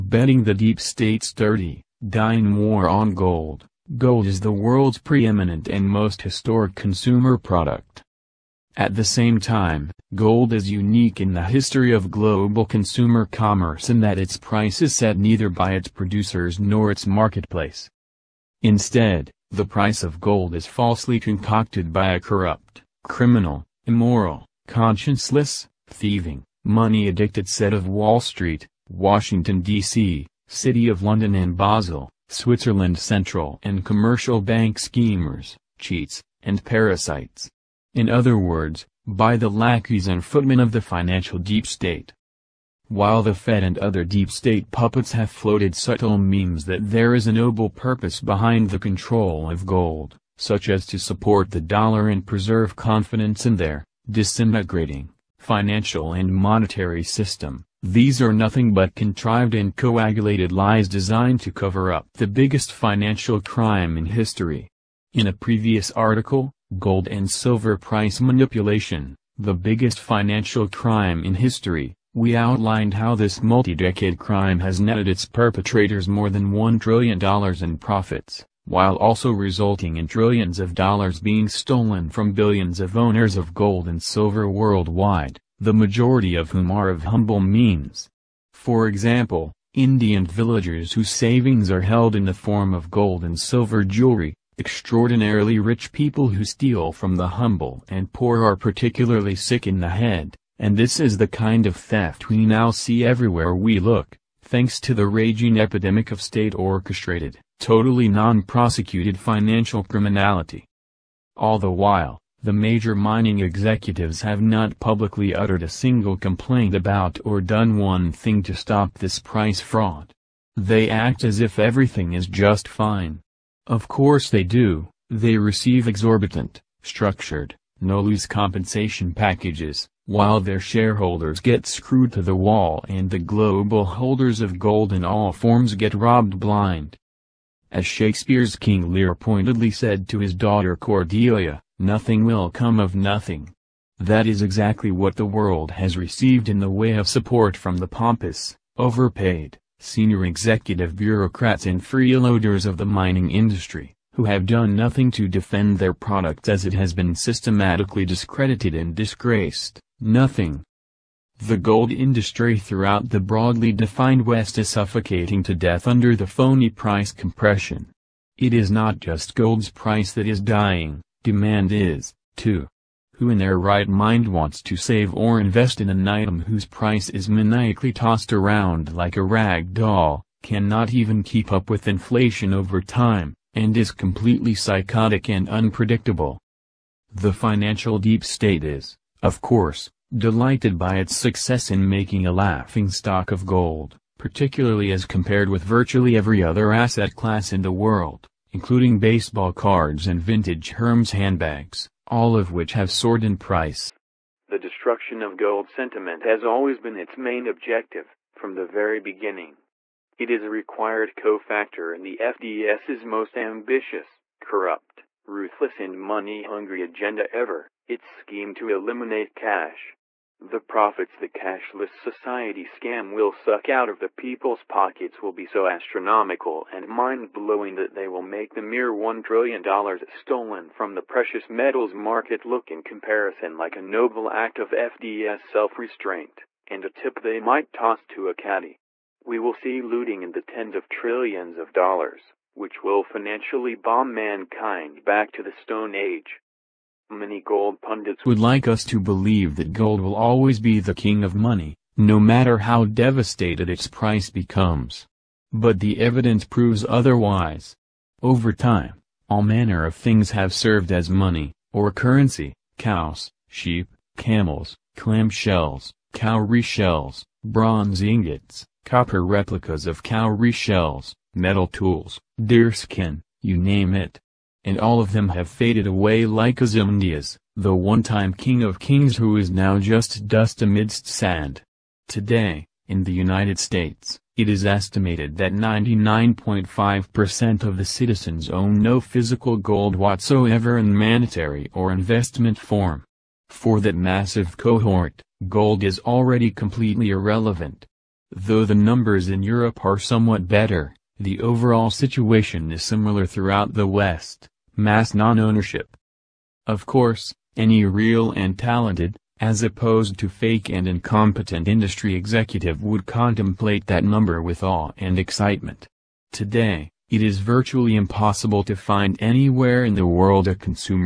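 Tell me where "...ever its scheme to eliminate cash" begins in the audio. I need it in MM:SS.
03:37.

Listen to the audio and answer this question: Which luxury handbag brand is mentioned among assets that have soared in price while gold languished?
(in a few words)
Hermes.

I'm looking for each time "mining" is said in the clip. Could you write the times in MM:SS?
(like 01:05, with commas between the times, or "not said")
01:52, 02:32.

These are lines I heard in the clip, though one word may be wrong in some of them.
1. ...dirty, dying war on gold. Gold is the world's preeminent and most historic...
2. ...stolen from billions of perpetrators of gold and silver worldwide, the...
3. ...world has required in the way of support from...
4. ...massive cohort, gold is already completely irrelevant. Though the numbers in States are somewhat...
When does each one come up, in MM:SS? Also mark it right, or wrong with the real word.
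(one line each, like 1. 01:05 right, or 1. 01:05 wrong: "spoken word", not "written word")
1. 00:01 right
2. 01:21 wrong: "owners", not "perpetrators"
3. 02:25 wrong: "received", not "required"
4. 04:53 wrong: "Europe", not "States".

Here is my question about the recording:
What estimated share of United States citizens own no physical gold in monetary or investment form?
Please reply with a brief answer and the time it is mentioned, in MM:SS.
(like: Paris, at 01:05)
99.5%, at 04:45.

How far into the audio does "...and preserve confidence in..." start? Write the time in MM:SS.
00:52.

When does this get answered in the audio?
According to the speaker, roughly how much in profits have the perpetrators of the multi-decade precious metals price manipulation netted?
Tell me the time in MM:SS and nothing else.
01:16.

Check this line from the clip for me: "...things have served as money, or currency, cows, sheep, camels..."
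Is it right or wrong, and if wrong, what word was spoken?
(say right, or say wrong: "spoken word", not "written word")
right.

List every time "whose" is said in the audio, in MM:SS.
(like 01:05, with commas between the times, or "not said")
01:30, 02:56.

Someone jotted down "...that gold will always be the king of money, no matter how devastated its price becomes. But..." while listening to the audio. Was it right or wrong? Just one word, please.
right.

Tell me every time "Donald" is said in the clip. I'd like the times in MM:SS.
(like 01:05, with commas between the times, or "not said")
not said.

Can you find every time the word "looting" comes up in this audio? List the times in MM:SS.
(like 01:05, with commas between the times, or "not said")
03:59.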